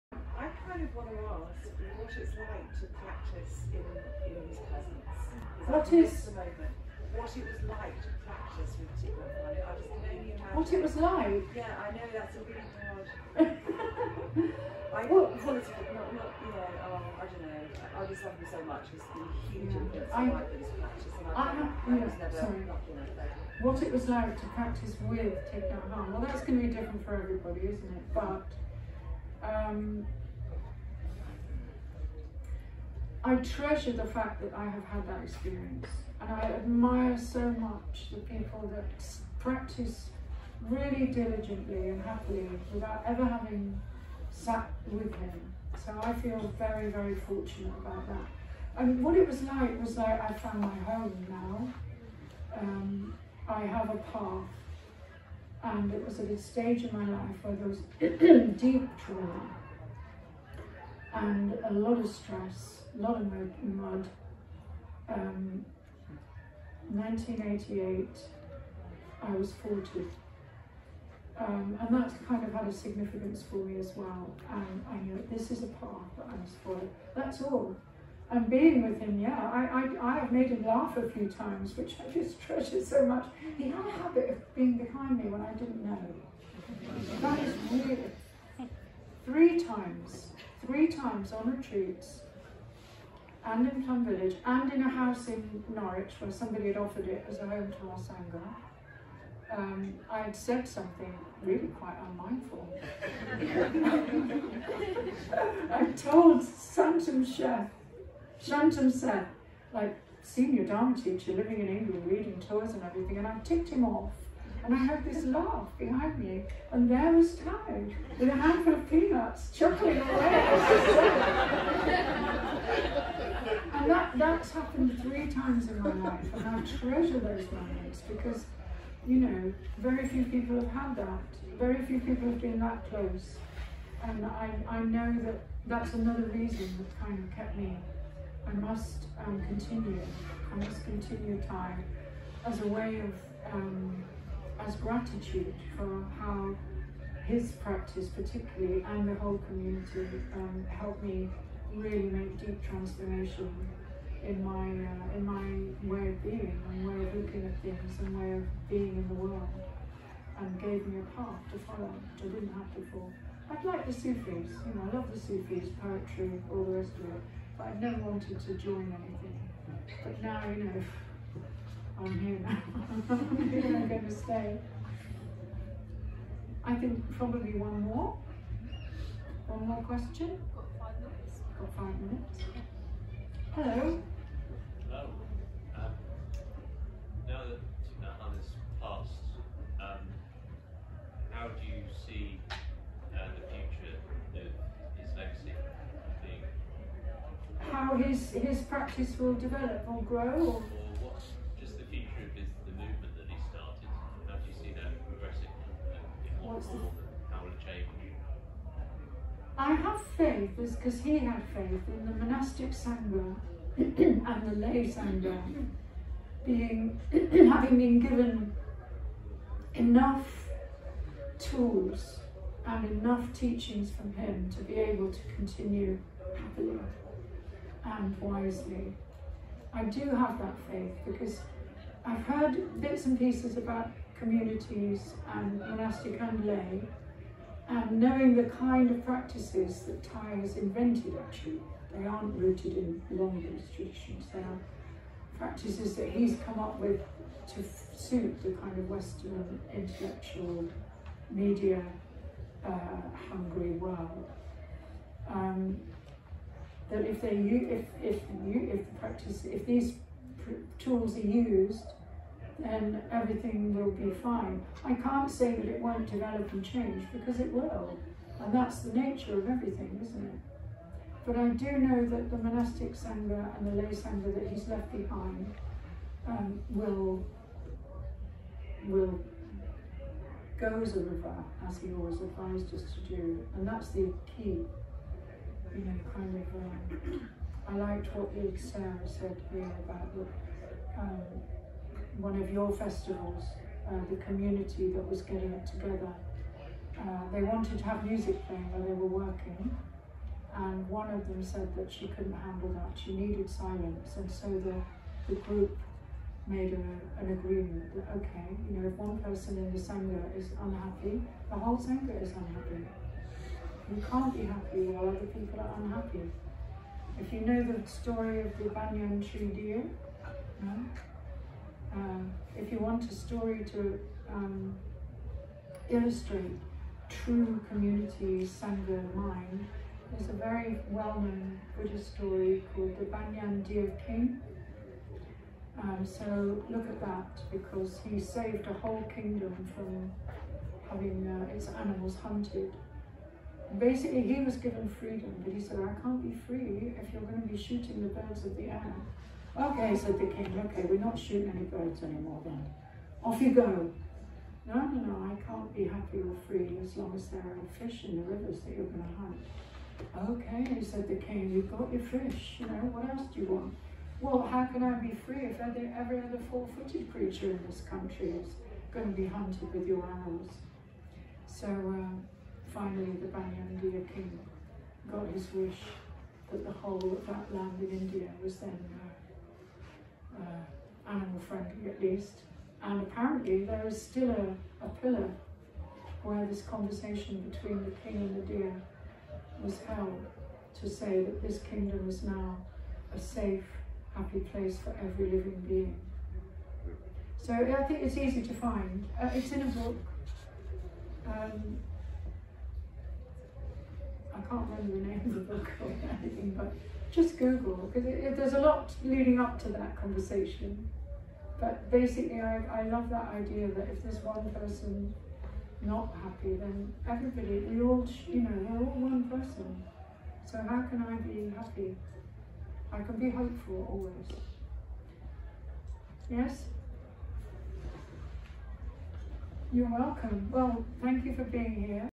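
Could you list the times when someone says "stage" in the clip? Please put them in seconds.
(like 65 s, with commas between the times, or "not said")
56 s.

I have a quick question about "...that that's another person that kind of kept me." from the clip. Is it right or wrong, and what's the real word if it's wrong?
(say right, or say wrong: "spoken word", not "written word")
wrong: "reason", not "person".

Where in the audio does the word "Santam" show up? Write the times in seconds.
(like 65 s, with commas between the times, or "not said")
106 s.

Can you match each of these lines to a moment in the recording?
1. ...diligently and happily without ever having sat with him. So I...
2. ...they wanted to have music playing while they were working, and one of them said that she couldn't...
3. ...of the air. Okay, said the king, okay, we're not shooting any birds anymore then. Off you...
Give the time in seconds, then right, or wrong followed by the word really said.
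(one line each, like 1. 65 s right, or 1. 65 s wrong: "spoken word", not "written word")
1. 41 s right
2. 297 s right
3. 348 s right.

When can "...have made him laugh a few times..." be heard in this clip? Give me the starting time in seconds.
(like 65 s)
80 s.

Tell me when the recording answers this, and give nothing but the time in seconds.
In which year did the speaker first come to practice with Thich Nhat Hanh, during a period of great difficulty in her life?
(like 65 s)
66 s.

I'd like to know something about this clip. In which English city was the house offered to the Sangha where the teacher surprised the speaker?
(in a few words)
Norwich.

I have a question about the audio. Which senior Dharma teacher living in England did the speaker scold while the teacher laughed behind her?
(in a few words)
Shantam Seth.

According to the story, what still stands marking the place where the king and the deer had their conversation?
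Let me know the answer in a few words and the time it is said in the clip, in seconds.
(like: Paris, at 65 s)
a pillar, at 384 s.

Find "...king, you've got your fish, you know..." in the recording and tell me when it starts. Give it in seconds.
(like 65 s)
361 s.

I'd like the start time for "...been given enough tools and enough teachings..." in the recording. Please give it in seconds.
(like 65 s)
217 s.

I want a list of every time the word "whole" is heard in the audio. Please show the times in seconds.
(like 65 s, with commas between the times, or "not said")
149 s, 311 s, 338 s, 376 s.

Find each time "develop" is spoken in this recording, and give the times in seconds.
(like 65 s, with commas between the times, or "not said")
199 s, 266 s.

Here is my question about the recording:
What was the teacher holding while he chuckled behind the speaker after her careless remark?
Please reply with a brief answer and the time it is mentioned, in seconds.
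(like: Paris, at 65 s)
peanuts, at 118 s.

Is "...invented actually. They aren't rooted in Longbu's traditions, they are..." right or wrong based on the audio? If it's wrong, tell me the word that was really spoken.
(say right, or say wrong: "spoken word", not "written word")
right.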